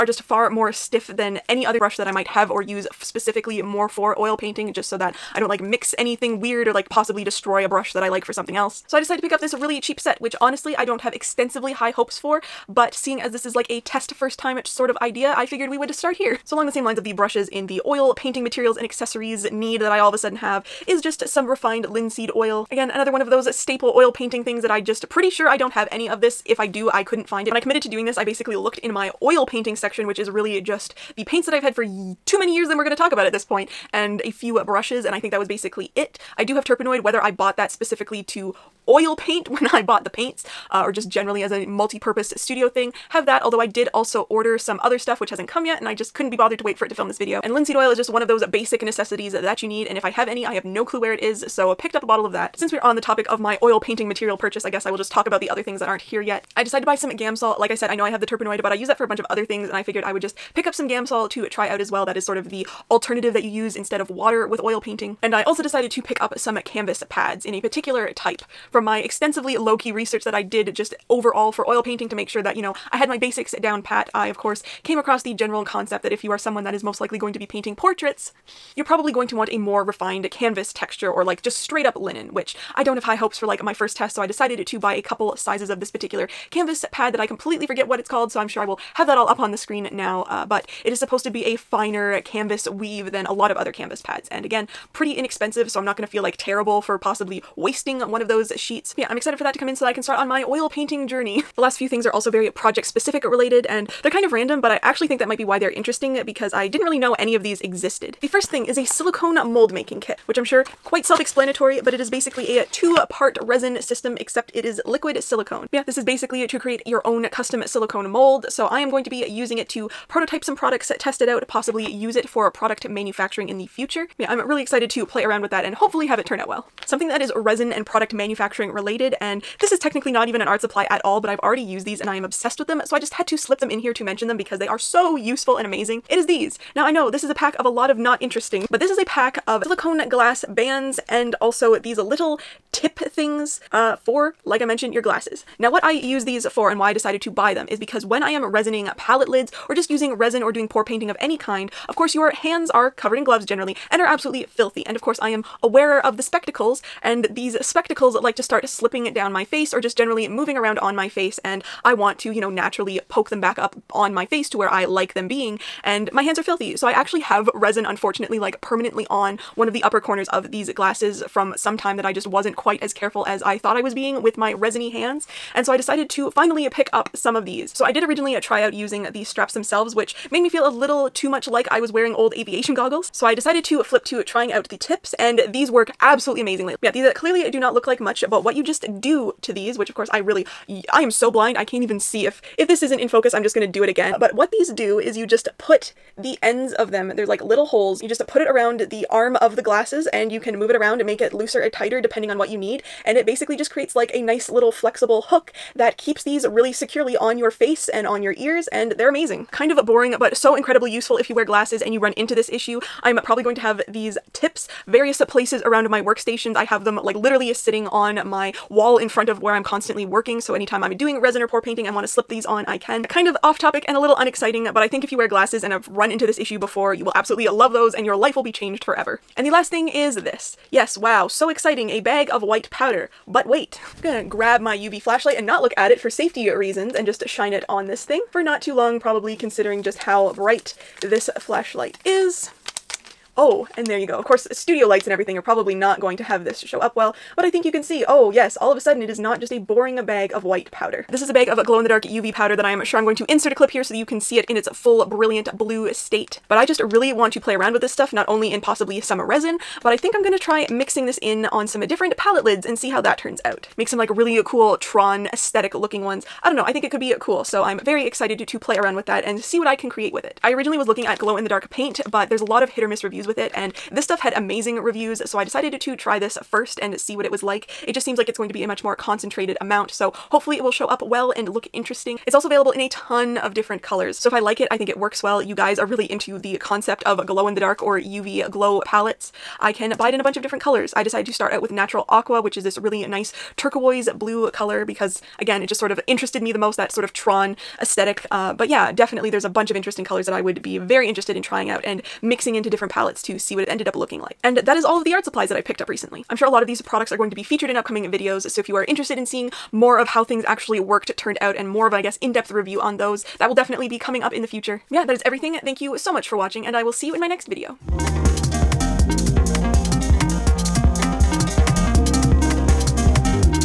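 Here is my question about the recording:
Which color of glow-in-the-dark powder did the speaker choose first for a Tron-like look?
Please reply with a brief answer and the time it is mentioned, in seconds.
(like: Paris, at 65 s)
Natural Aqua, at 291 s.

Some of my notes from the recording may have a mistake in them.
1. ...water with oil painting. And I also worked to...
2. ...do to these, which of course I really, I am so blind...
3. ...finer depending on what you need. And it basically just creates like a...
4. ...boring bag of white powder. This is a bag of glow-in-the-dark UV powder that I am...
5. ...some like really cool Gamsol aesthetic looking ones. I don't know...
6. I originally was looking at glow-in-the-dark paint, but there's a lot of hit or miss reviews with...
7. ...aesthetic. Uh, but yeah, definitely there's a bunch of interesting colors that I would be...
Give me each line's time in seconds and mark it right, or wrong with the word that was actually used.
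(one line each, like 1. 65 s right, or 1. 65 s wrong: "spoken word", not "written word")
1. 64 s wrong: "decided", not "worked"
2. 189 s right
3. 201 s wrong: "tighter", not "finer"
4. 249 s right
5. 263 s wrong: "Tron", not "Gamsol"
6. 270 s right
7. 297 s right.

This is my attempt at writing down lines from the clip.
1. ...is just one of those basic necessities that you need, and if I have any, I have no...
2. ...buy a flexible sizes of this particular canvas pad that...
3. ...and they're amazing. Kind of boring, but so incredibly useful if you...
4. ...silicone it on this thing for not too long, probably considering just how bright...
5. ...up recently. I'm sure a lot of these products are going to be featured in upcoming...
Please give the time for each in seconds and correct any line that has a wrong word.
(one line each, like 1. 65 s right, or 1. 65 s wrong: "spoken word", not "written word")
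1. 47 s right
2. 84 s wrong: "couple", not "flexible"
3. 208 s right
4. 237 s wrong: "shine", not "silicone"
5. 305 s right.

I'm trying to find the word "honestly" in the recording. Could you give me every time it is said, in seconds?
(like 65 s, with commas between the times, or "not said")
10 s.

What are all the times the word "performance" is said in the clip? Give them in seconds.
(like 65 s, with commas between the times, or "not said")
not said.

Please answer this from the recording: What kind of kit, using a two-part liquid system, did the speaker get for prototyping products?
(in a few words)
silicone mold making kit.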